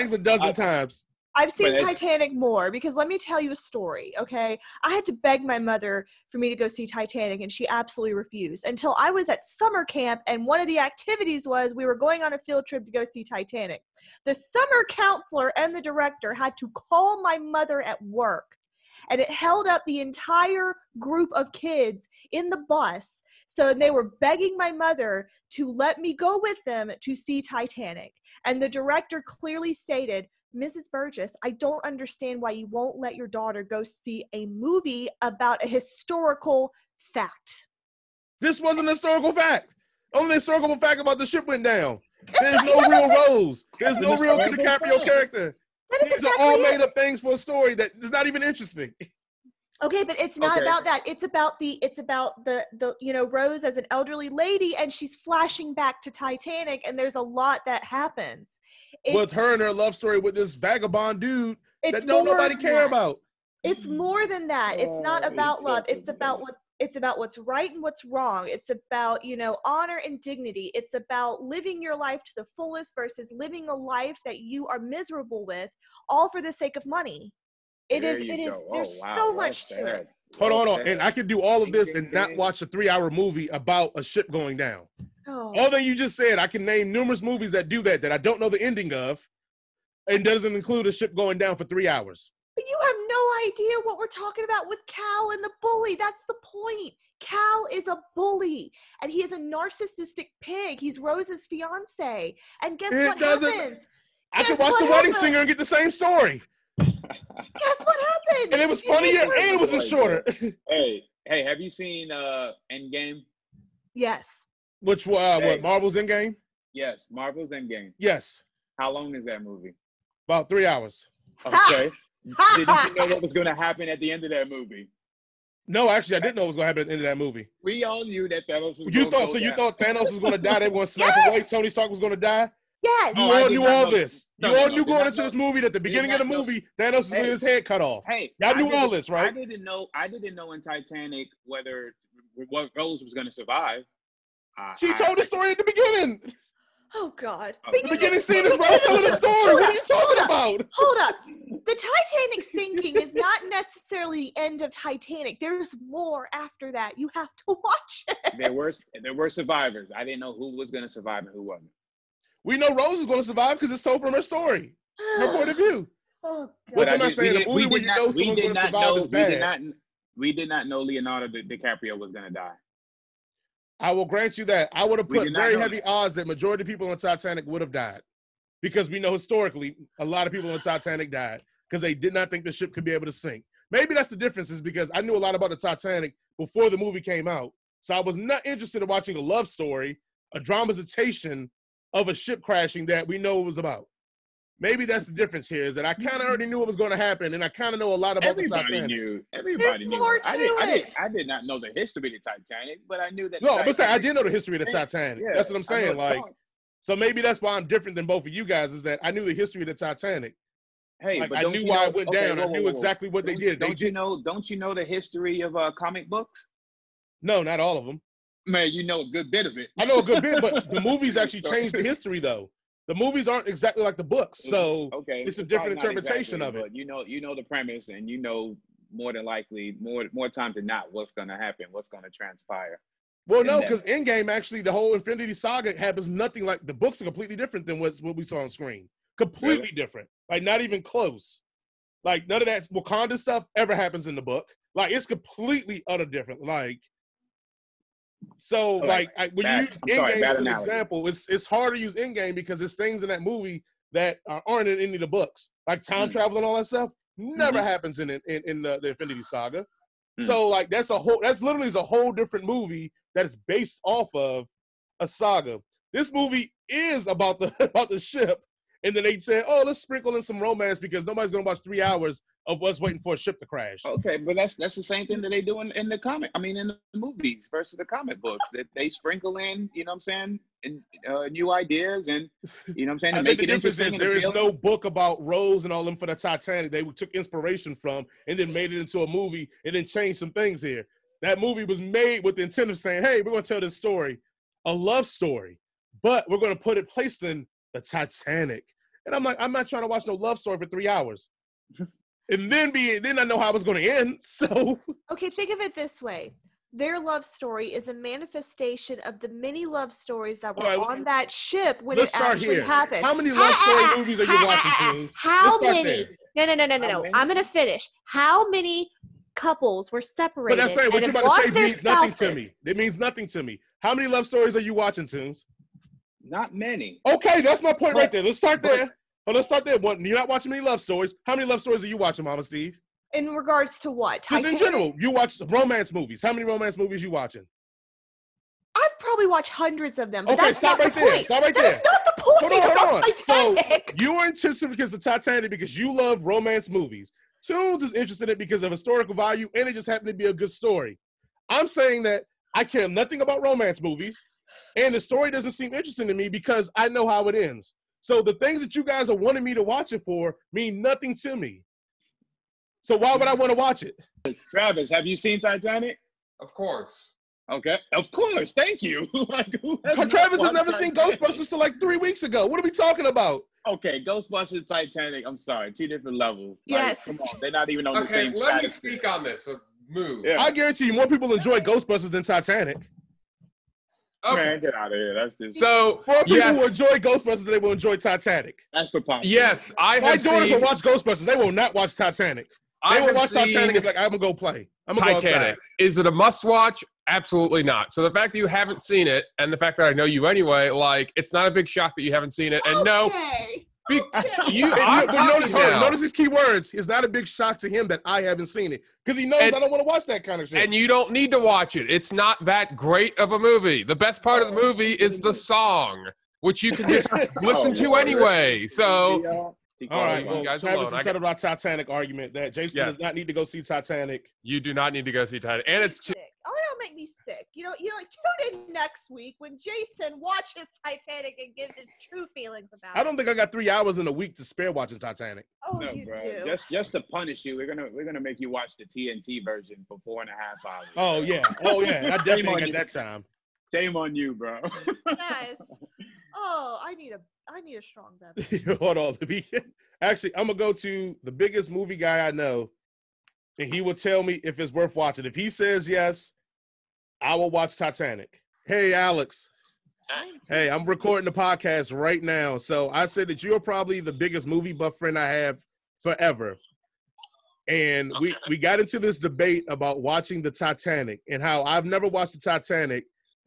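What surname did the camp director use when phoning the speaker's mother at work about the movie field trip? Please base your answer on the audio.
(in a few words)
Burgess.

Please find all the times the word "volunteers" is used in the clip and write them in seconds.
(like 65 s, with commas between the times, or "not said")
not said.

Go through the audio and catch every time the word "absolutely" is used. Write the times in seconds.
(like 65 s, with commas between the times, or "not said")
7 s, 397 s.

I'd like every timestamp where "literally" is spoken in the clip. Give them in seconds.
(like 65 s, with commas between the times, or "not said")
261 s.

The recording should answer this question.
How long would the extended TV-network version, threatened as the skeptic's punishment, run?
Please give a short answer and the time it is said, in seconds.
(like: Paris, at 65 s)
4.5 hours, at 440 s.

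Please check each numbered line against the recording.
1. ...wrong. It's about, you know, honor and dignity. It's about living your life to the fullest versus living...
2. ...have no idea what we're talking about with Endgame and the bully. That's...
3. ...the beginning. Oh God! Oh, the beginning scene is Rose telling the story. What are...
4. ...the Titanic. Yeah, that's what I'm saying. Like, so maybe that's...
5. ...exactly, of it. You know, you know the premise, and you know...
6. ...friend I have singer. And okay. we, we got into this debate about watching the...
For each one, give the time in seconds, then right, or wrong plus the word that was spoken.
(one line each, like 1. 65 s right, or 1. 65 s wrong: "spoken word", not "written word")
1. 68 s right
2. 92 s wrong: "Cal", not "Endgame"
3. 145 s right
4. 204 s right
5. 226 s right
6. 464 s wrong: "forever", not "singer".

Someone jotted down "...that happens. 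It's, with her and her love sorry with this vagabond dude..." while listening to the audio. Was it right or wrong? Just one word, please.
wrong.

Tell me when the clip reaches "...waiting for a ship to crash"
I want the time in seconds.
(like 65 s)
272 s.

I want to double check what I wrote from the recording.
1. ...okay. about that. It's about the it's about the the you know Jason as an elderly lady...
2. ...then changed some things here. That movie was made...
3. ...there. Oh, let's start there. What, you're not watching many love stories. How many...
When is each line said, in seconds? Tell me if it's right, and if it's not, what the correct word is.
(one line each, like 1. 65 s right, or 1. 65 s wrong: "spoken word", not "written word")
1. 50 s wrong: "Rose", not "Jason"
2. 289 s right
3. 328 s right.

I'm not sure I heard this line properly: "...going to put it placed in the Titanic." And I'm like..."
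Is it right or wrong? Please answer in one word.
right.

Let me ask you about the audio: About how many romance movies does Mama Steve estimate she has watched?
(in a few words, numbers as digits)
Hundreds.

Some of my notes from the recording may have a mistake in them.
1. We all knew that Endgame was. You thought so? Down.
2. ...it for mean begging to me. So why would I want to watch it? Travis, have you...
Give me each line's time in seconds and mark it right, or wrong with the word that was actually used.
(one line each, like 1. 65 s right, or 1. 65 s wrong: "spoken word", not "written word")
1. 127 s wrong: "Thanos", not "Endgame"
2. 359 s wrong: "nothing", not "begging".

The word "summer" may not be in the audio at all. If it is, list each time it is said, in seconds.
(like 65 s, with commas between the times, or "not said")
9 s, 14 s.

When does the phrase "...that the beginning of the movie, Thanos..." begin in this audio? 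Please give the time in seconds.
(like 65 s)
135 s.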